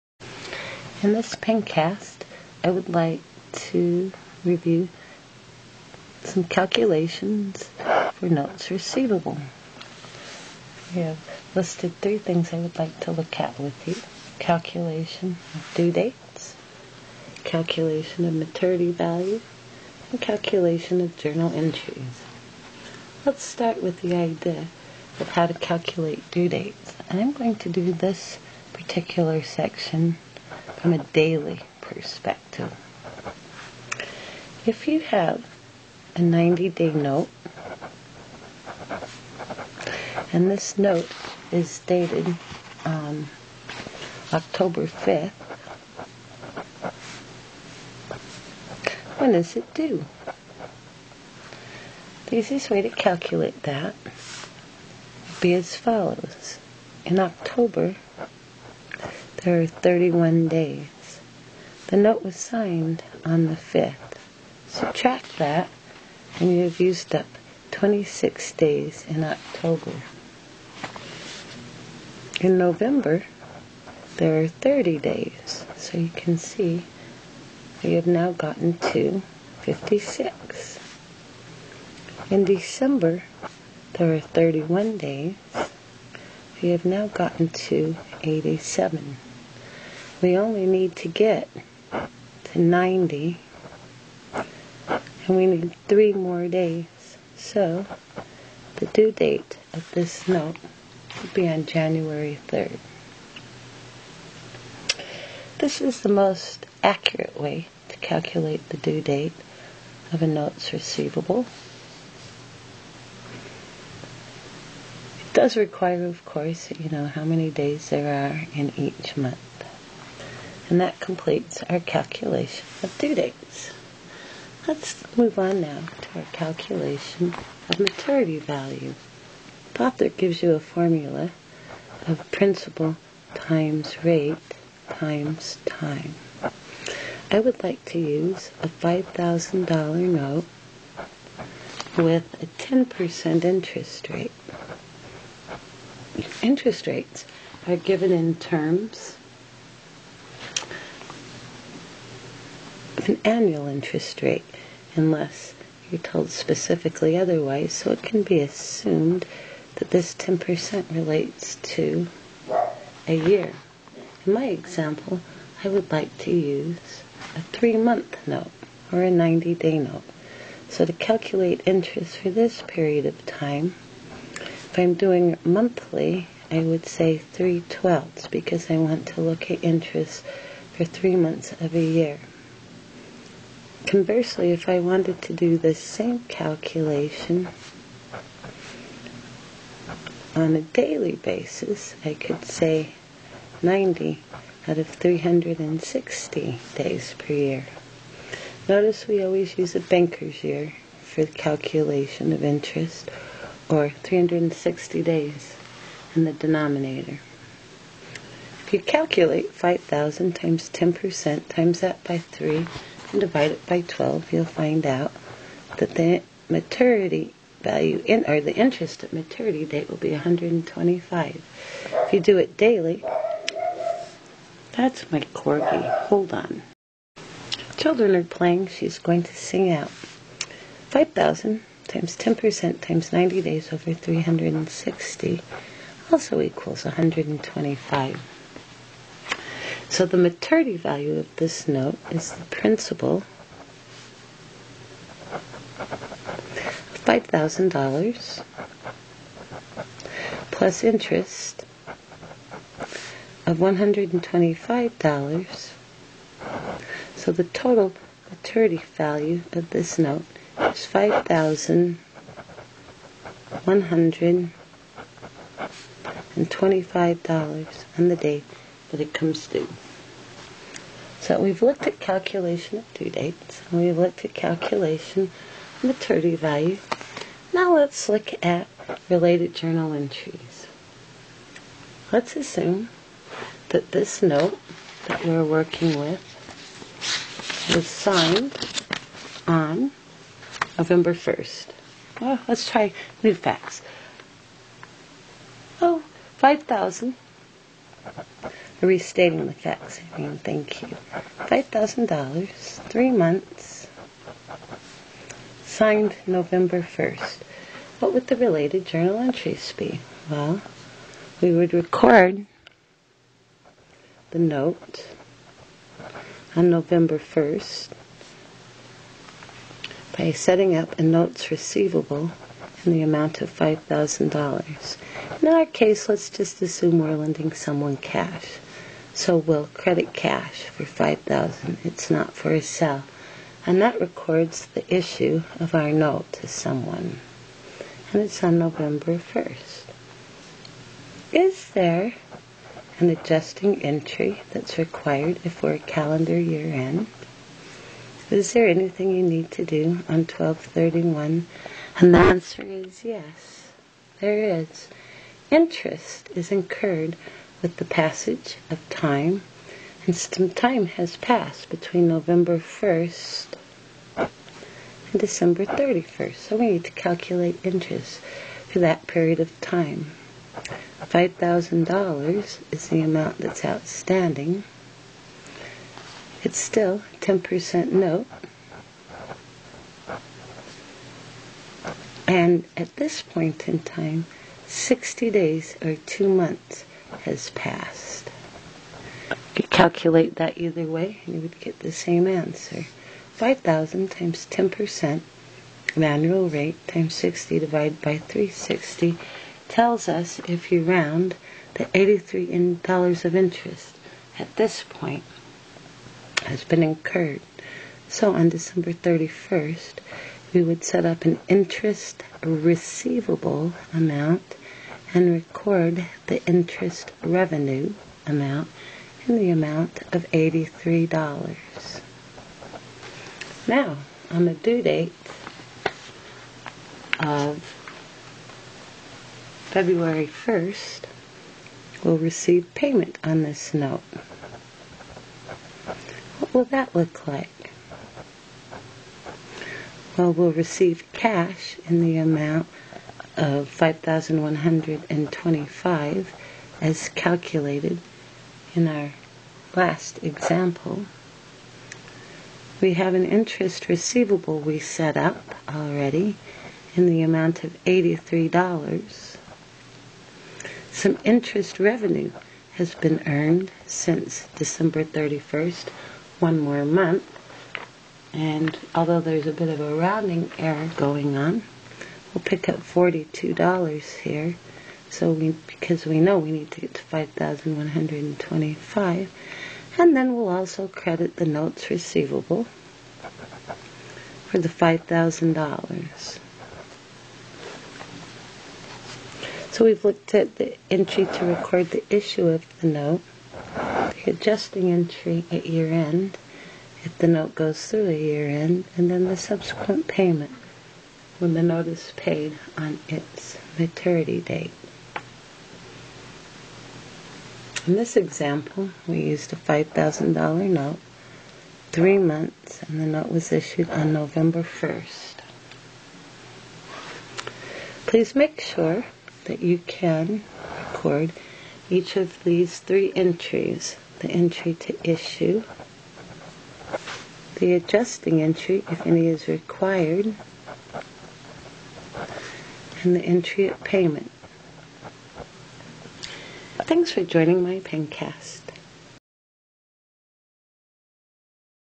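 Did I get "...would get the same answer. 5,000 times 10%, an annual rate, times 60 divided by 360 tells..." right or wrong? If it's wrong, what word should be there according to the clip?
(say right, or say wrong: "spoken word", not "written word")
right.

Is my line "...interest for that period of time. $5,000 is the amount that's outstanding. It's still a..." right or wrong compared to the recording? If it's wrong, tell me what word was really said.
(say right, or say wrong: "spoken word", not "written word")
right.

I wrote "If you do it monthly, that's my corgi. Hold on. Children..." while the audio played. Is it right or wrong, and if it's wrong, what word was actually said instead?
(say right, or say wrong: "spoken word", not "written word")
wrong: "daily", not "monthly".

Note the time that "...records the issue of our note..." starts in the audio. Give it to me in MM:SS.
05:34.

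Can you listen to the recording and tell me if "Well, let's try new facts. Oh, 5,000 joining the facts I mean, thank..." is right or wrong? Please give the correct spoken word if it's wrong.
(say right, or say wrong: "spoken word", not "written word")
wrong: "restating", not "joining".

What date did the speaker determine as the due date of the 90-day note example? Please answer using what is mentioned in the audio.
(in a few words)
January 3rd.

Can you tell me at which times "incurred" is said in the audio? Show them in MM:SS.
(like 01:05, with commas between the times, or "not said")
05:56, 06:46.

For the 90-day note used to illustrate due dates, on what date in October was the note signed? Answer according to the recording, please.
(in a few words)
October 5th.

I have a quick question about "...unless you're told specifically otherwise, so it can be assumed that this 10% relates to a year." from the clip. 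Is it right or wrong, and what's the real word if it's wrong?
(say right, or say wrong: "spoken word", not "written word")
right.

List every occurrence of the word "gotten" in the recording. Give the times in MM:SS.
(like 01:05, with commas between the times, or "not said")
01:18, 01:27.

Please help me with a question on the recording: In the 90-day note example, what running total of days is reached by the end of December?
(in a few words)
87.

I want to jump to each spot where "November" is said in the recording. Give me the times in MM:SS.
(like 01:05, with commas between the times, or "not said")
01:12, 04:50, 05:06, 05:16, 05:38, 06:02, 08:34.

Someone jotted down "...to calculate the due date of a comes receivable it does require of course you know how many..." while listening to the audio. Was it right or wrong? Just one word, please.
wrong.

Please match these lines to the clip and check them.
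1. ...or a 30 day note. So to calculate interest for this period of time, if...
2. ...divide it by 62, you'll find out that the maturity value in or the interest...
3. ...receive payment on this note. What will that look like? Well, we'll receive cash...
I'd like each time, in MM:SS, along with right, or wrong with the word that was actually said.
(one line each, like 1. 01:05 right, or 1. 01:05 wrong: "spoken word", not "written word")
1. 02:48 wrong: "90", not "30"
2. 03:33 wrong: "12", not "62"
3. 07:12 right.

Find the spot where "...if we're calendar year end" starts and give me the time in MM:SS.
05:45.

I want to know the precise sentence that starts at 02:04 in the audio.
Let's move on now to our calculation of maturity value.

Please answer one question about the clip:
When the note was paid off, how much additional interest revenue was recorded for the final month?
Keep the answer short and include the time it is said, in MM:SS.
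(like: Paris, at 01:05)
$42, at 07:52.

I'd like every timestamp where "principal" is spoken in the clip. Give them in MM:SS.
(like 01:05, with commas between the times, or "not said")
02:12, 04:02.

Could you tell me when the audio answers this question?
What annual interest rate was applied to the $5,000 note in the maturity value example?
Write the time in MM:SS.
02:22.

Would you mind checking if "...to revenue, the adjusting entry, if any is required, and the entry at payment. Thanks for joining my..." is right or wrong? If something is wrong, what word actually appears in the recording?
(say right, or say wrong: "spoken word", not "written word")
wrong: "issue", not "revenue".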